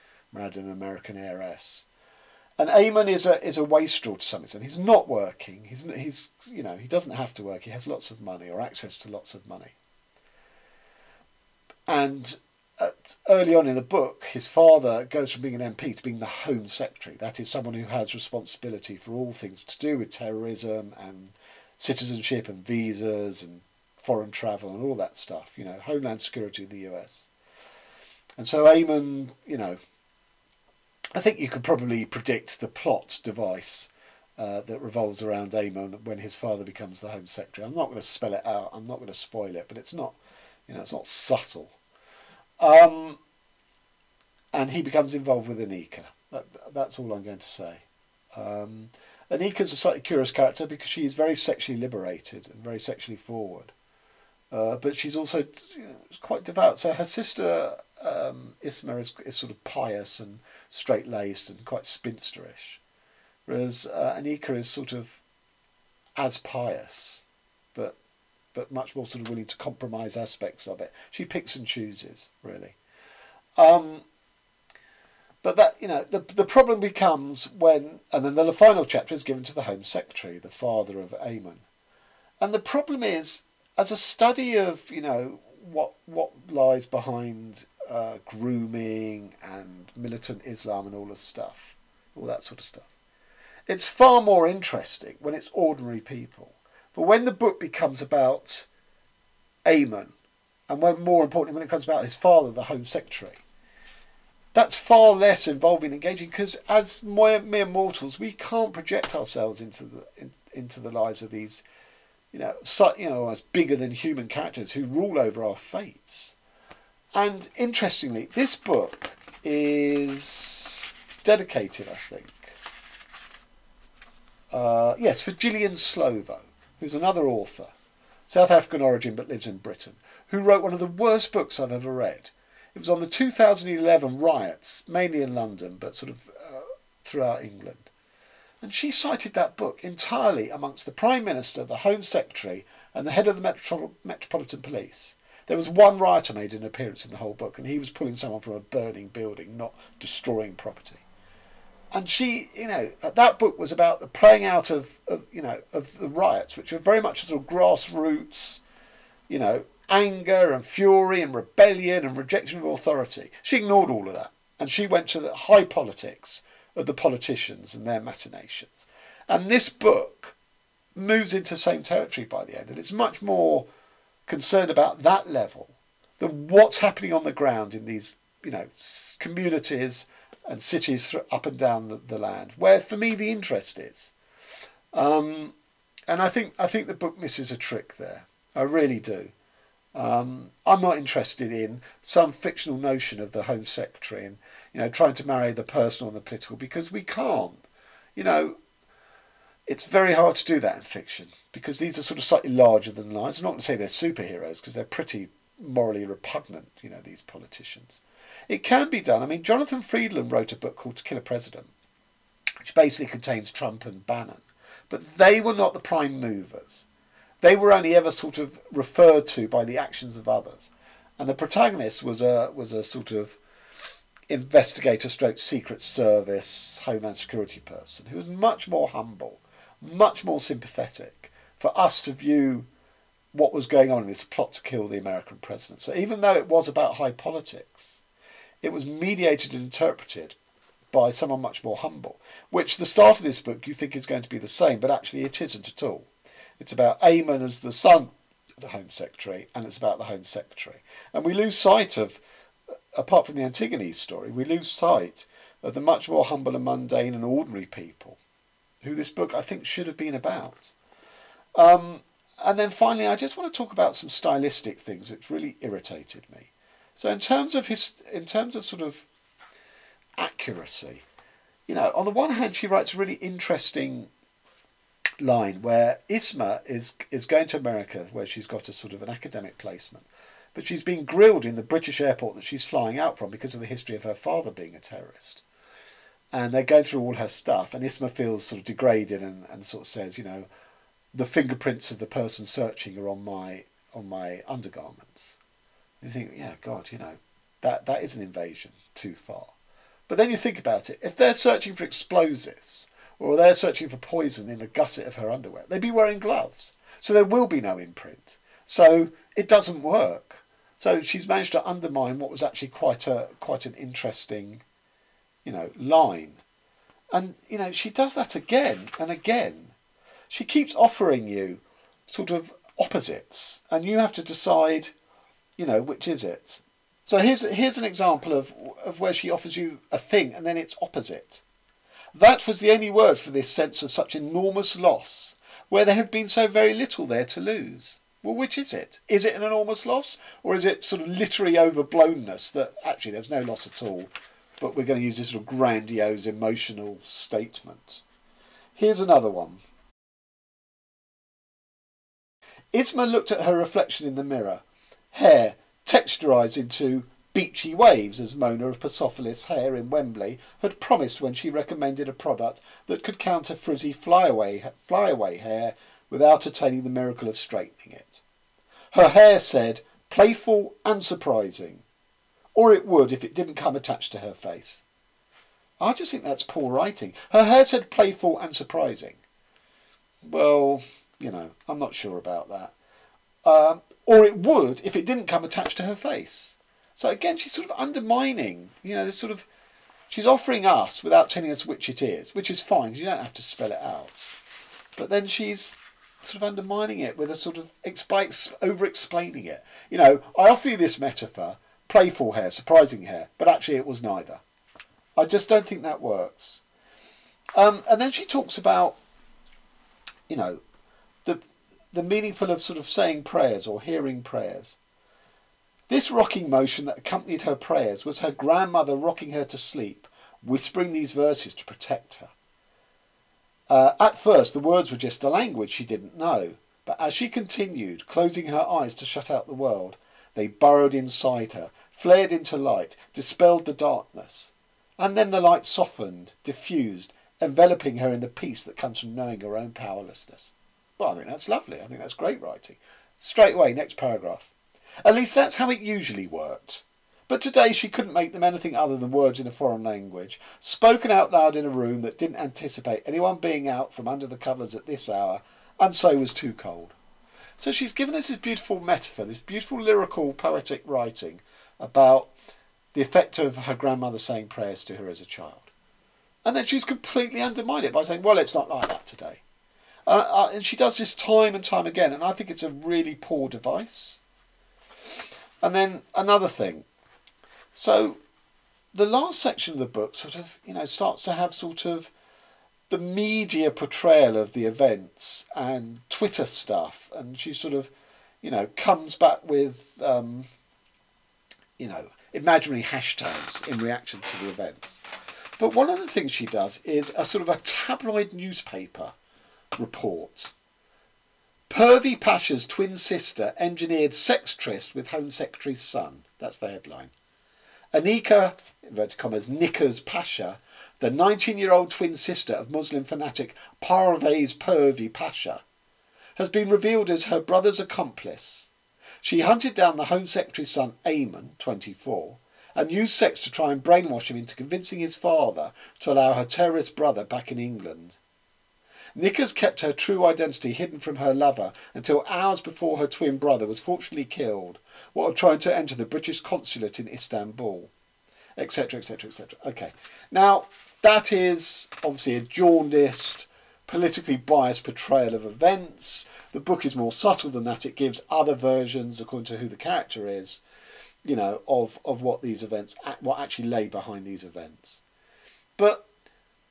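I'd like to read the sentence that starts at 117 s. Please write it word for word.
And interestingly, this book is dedicated, I think.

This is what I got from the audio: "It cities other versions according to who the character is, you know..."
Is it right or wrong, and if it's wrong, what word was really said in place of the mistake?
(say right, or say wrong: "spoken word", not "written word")
wrong: "gives", not "cities".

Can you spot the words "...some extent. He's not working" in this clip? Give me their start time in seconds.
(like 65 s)
4 s.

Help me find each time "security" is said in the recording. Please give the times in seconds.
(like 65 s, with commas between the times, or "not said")
26 s, 227 s.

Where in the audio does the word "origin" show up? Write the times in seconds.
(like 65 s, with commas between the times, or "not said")
128 s.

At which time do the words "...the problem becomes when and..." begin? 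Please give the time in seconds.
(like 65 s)
76 s.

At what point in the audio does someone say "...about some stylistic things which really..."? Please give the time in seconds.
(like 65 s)
263 s.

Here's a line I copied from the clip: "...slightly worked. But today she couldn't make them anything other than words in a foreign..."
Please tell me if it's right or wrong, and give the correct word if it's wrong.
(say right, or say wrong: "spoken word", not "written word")
wrong: "usually", not "slightly".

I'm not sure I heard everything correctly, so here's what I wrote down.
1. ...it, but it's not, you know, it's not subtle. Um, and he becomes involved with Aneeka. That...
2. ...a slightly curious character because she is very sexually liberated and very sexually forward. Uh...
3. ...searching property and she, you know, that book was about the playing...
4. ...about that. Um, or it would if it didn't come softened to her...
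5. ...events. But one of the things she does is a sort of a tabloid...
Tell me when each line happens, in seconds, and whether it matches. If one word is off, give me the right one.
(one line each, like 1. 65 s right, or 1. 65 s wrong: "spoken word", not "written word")
1. 39 s right
2. 49 s right
3. 149 s wrong: "destroying", not "searching"
4. 382 s wrong: "attached", not "softened"
5. 494 s right.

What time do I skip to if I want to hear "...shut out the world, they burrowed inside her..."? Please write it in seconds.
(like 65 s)
429 s.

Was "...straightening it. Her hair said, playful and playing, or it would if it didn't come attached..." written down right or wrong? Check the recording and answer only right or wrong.
wrong.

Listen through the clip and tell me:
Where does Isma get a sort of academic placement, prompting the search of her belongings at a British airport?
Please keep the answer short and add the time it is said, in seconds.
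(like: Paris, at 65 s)
America, at 277 s.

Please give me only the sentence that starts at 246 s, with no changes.
It's about Eamonn as the son of the Home Secretary, and it's about the Home Secretary.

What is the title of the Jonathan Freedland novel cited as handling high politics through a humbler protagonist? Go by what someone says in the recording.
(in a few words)
To Kill a President.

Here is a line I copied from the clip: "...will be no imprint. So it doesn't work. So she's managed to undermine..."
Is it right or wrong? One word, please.
right.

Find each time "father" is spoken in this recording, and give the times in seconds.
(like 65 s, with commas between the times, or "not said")
14 s, 36 s, 80 s, 102 s, 284 s, 525 s.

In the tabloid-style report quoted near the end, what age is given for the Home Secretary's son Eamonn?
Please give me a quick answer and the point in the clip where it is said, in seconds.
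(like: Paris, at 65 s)
24, at 521 s.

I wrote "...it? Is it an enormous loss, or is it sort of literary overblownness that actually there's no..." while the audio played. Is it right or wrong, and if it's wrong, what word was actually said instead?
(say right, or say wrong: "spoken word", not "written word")
right.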